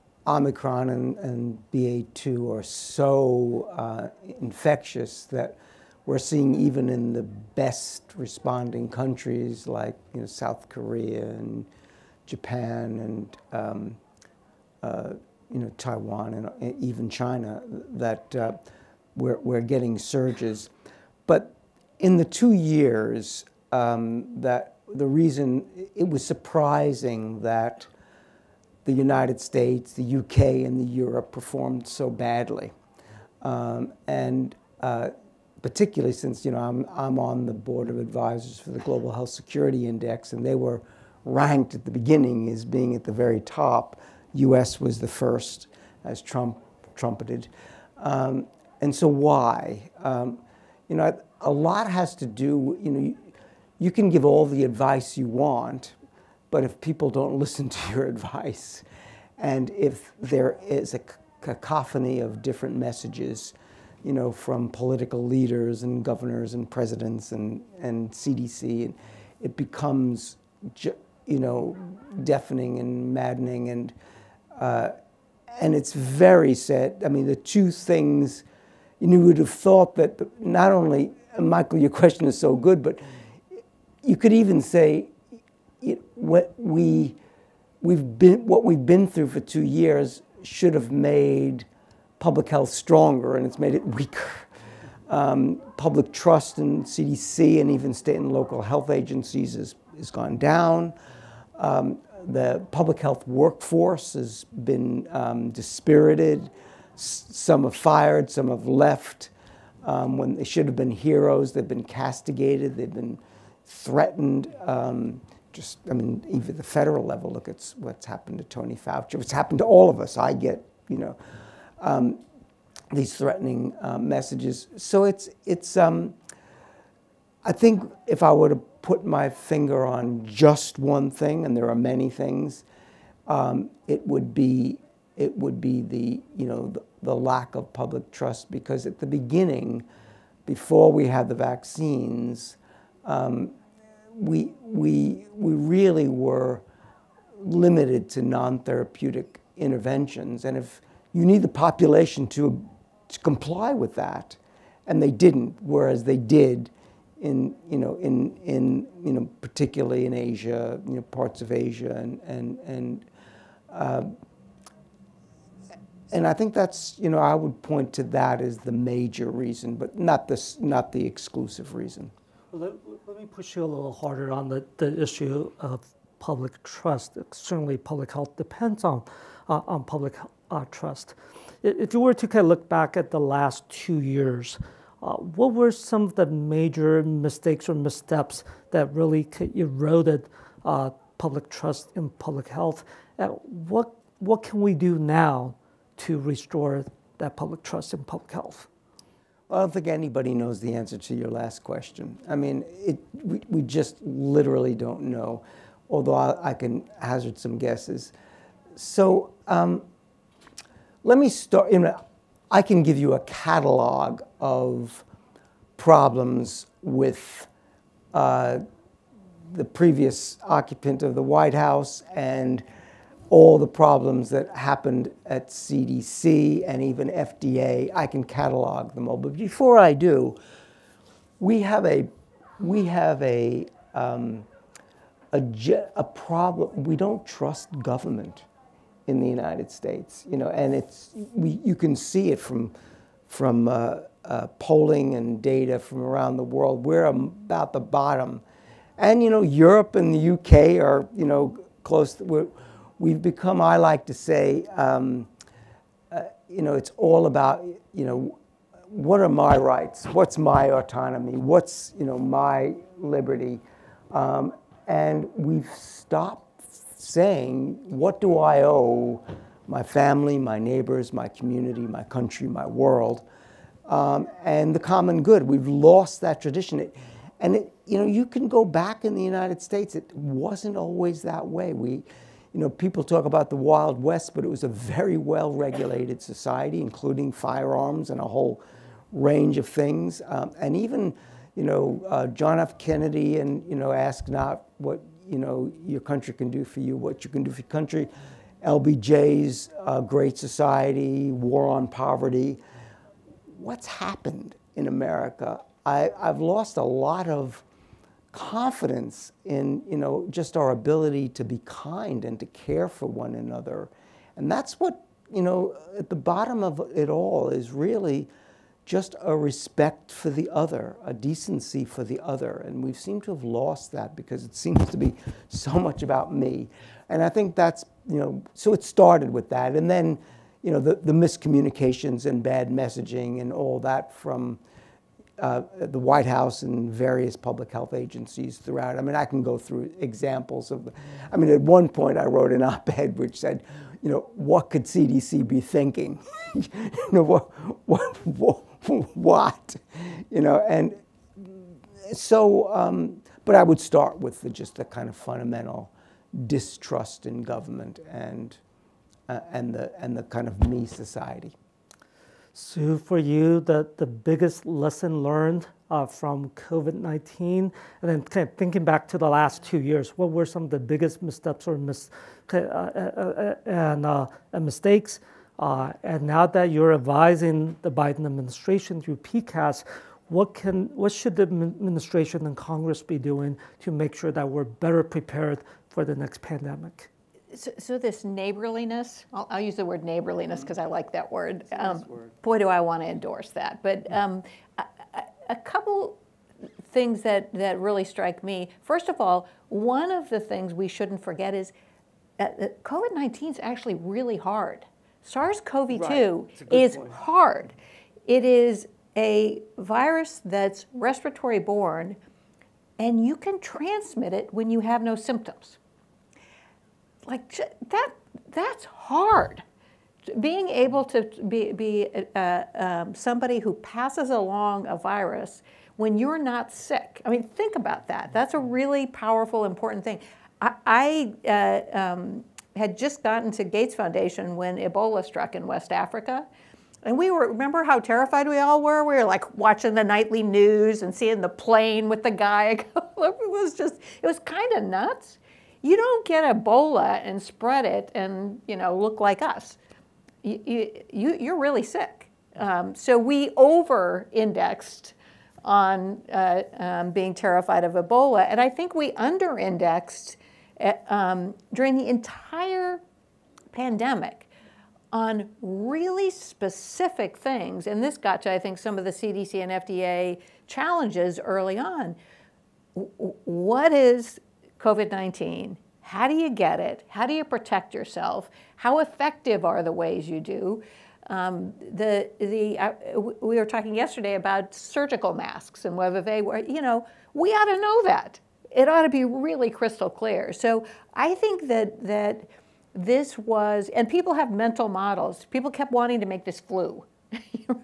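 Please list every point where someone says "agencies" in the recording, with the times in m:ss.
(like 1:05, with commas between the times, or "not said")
1:38, 5:37.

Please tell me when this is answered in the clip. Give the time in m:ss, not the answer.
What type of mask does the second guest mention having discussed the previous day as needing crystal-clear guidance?
8:04.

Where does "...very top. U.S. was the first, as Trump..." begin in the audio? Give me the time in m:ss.
0:43.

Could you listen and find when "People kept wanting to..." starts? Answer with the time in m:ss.
8:15.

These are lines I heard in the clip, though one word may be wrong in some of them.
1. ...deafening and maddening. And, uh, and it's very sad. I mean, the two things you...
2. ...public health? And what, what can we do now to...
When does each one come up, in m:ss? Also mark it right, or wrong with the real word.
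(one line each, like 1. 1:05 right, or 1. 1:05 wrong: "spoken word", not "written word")
1. 1:12 right
2. 3:12 right.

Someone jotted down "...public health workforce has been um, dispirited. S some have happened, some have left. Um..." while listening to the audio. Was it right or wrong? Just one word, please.
wrong.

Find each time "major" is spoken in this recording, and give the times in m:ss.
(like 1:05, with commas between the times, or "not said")
2:48, 3:06.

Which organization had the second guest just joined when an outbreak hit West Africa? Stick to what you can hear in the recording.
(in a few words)
Gates Foundation.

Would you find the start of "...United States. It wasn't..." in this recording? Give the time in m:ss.
4:39.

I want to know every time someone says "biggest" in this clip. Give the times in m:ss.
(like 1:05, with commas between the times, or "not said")
6:04, 6:10.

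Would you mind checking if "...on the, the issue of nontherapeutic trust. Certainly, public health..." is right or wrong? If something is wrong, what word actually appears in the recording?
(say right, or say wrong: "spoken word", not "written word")
wrong: "public", not "nontherapeutic".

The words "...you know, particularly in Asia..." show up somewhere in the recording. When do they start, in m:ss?
2:39.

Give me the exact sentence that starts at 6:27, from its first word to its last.
So, so this neighborliness, I'll, I'll, use the word neighborliness because I like that word.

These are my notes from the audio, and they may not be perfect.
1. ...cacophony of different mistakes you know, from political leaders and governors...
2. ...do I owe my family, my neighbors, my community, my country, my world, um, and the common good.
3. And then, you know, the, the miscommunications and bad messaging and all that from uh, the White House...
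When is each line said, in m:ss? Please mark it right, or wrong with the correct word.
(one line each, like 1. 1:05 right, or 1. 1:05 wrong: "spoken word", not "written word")
1. 1:01 wrong: "messages", not "mistakes"
2. 4:28 right
3. 5:29 right.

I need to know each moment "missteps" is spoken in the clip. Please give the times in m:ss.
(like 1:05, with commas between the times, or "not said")
3:07, 6:11.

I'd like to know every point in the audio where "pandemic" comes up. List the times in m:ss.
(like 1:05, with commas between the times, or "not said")
6:26, 7:43.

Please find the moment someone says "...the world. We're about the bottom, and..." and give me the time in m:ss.
4:06.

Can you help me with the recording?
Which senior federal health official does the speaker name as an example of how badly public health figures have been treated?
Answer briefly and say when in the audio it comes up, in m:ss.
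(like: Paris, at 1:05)
Tony Fauci, at 1:58.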